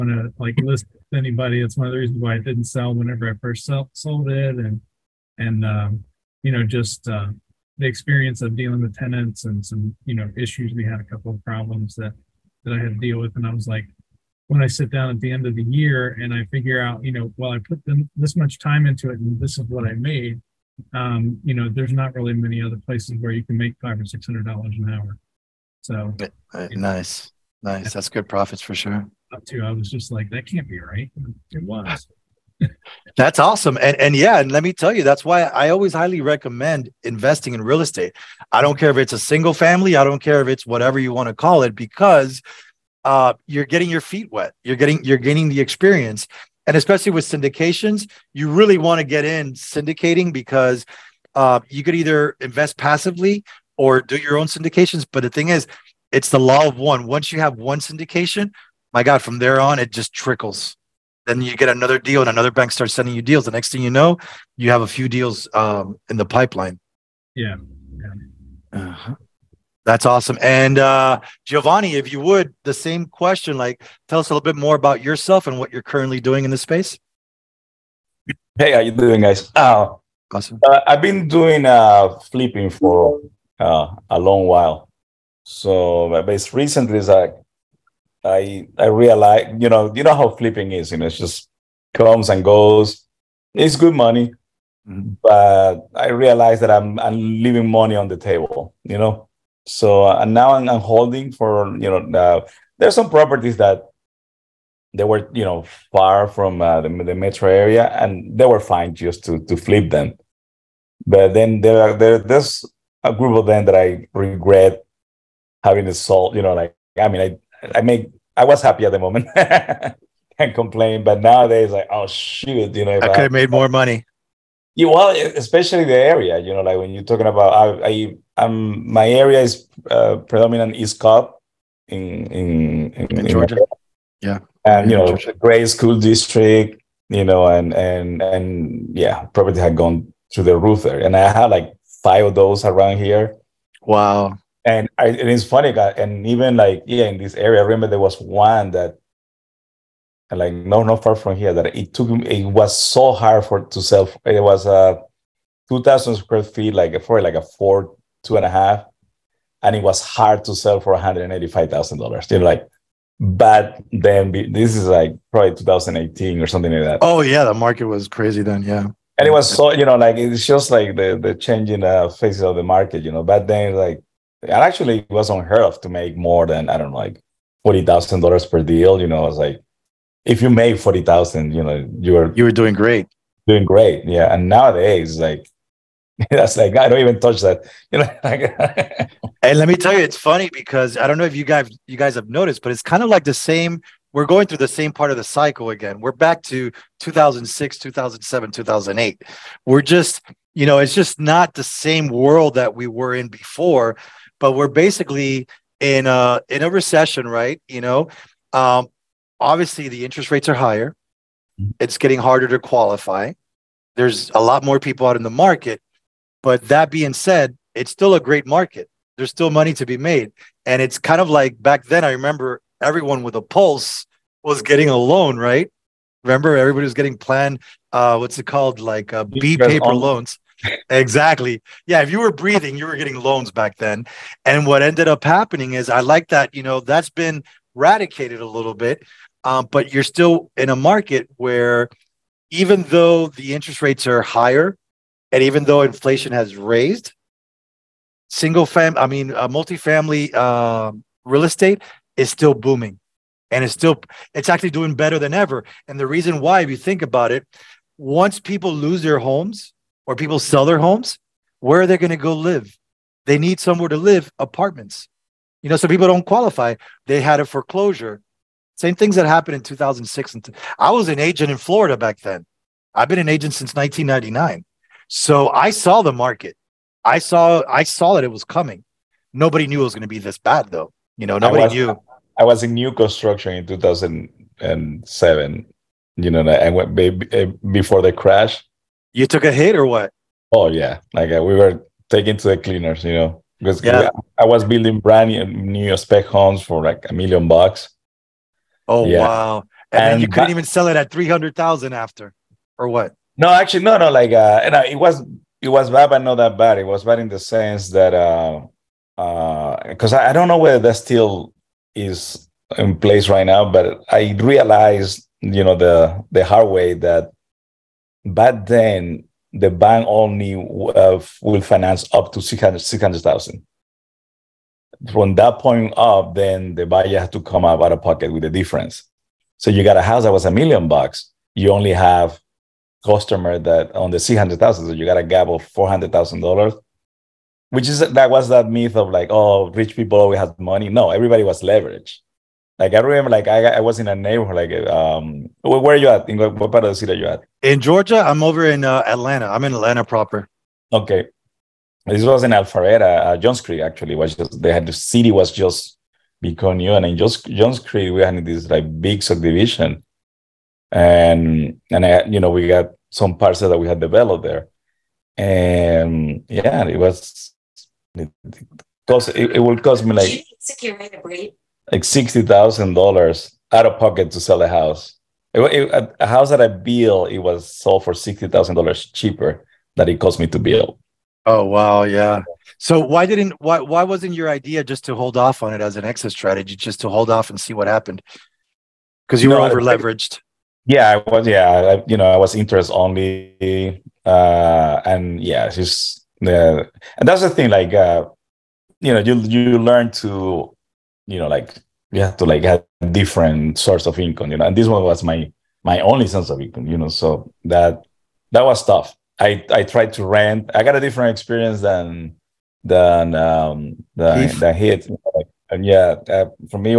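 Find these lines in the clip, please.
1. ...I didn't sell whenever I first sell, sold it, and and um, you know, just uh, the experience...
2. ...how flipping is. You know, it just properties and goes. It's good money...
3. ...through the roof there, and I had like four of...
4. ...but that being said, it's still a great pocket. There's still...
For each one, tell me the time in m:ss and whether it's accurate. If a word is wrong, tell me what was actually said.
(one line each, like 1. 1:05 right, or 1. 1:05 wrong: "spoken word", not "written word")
1. 0:02 right
2. 1:30 wrong: "comes", not "properties"
3. 2:20 wrong: "five", not "four"
4. 3:36 wrong: "market", not "pocket".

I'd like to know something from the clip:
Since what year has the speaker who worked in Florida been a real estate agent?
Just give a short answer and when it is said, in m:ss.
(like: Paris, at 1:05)
1999, at 4:33.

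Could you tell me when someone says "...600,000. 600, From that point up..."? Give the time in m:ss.
5:22.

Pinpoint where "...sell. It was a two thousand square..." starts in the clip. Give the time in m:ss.
2:33.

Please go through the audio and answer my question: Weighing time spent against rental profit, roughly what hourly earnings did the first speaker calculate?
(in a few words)
500 or 600 dollars an hour.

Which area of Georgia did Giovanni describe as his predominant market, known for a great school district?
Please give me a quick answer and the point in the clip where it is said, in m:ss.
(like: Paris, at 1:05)
East Cobb, at 2:10.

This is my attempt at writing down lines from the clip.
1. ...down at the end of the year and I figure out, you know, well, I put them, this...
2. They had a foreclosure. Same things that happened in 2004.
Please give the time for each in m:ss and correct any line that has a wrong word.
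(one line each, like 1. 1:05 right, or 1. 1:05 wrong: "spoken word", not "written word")
1. 0:14 right
2. 4:27 wrong: "2006", not "2004".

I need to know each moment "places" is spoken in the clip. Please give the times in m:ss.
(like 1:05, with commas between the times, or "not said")
0:22, 5:12.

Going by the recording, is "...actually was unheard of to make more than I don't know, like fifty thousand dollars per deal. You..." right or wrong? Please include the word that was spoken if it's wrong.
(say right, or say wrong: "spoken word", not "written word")
wrong: "forty", not "fifty".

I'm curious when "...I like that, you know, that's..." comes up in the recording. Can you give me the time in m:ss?
3:55.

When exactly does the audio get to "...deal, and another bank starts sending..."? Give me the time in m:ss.
1:01.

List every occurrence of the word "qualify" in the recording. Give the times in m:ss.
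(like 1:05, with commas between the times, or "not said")
3:32, 4:26.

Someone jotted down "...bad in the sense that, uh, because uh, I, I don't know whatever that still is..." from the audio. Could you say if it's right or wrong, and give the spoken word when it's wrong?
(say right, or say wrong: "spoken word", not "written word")
wrong: "whether", not "whatever".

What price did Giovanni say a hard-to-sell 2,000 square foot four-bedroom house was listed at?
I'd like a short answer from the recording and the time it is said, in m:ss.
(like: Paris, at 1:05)
$185,000, at 2:40.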